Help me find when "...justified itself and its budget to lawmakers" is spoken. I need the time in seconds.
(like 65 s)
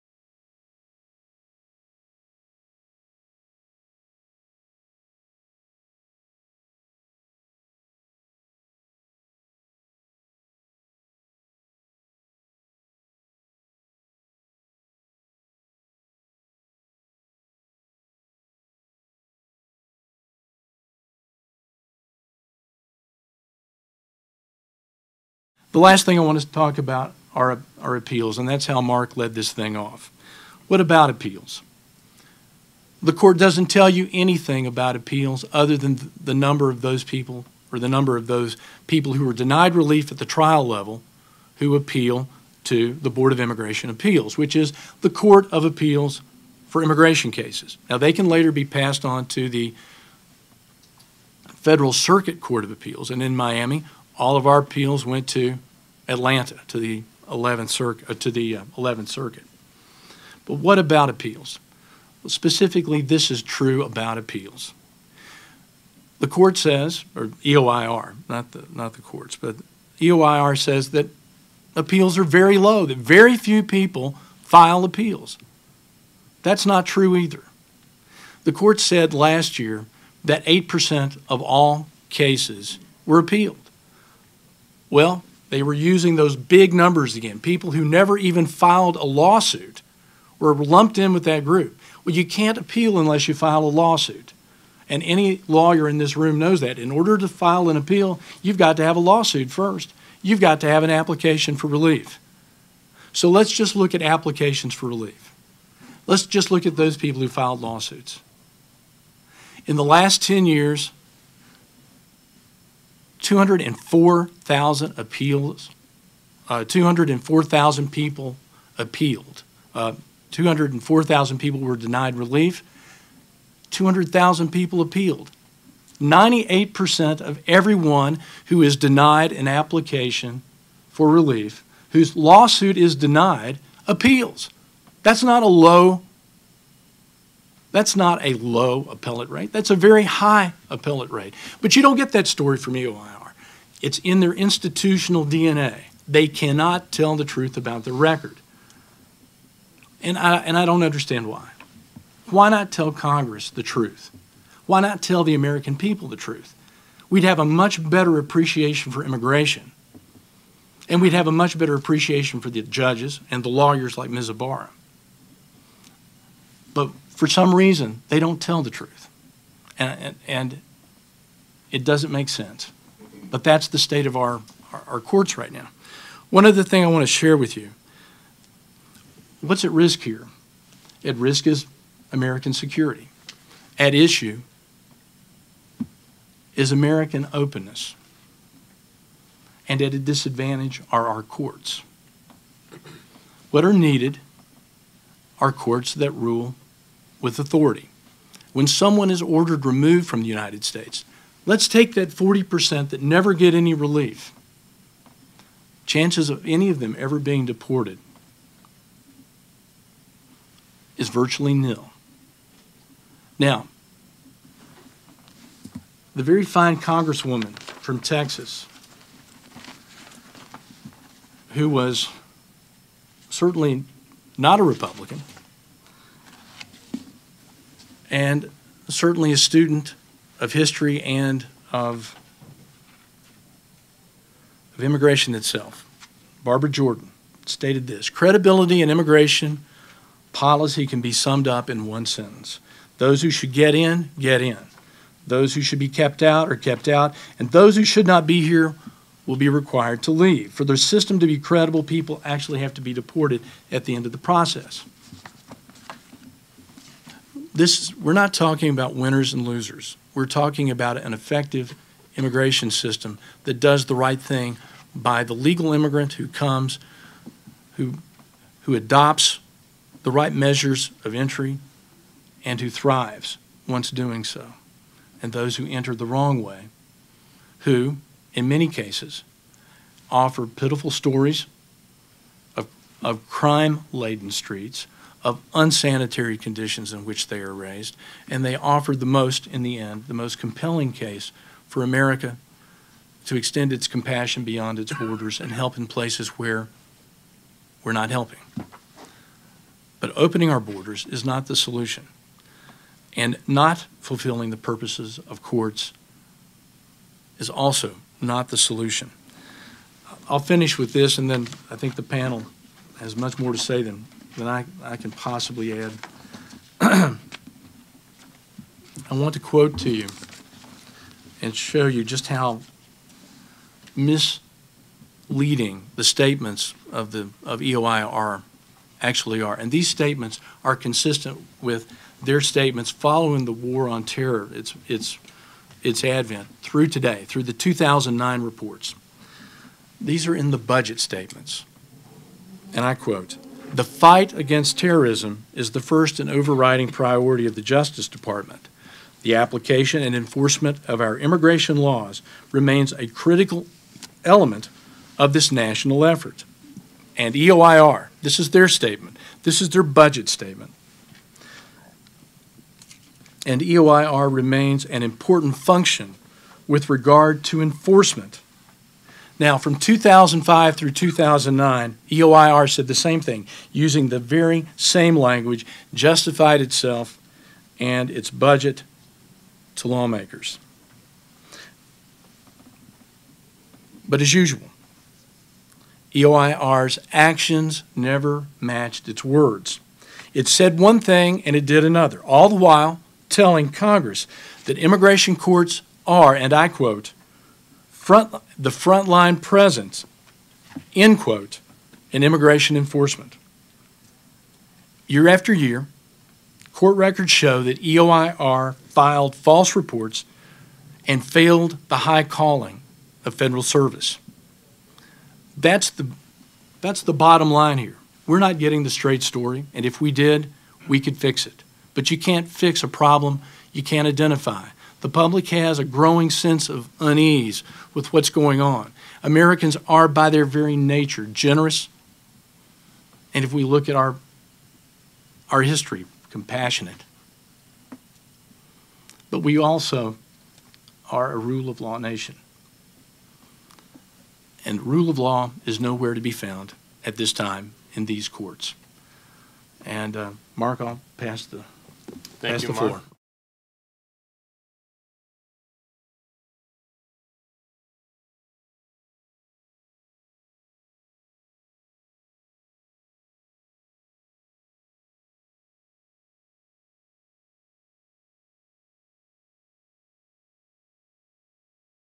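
375 s.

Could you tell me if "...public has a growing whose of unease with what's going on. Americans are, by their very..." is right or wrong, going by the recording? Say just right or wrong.
wrong.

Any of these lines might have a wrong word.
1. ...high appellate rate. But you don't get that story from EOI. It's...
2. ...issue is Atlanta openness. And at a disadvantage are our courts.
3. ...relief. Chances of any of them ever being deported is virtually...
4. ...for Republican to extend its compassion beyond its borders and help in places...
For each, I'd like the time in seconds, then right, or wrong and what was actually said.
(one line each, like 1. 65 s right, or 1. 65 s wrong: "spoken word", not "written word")
1. 140 s right
2. 183 s wrong: "American", not "Atlanta"
3. 203 s right
4. 291 s wrong: "America", not "Republican".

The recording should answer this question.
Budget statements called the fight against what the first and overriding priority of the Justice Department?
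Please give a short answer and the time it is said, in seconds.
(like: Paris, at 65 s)
terrorism, at 344 s.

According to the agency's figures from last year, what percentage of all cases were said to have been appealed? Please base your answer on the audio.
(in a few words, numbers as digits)
8%.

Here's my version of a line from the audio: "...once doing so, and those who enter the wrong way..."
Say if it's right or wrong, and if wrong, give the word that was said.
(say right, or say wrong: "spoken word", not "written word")
right.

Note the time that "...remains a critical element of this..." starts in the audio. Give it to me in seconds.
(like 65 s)
352 s.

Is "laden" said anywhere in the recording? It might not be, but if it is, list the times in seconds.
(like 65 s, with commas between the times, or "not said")
283 s.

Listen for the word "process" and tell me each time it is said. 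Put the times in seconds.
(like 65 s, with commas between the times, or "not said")
254 s.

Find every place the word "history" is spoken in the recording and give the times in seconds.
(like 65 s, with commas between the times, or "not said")
230 s, 435 s.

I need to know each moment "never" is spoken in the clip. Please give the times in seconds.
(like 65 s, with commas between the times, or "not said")
87 s, 203 s, 387 s.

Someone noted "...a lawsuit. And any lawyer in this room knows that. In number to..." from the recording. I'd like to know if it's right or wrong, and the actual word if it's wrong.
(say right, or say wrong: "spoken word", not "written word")
wrong: "order", not "number".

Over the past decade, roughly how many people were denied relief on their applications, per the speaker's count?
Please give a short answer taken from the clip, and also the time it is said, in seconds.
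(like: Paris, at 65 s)
204,000, at 120 s.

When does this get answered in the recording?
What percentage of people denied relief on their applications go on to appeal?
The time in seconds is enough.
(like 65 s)
126 s.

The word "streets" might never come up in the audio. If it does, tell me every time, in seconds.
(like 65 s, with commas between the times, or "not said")
284 s.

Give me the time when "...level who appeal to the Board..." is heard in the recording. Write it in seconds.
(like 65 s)
40 s.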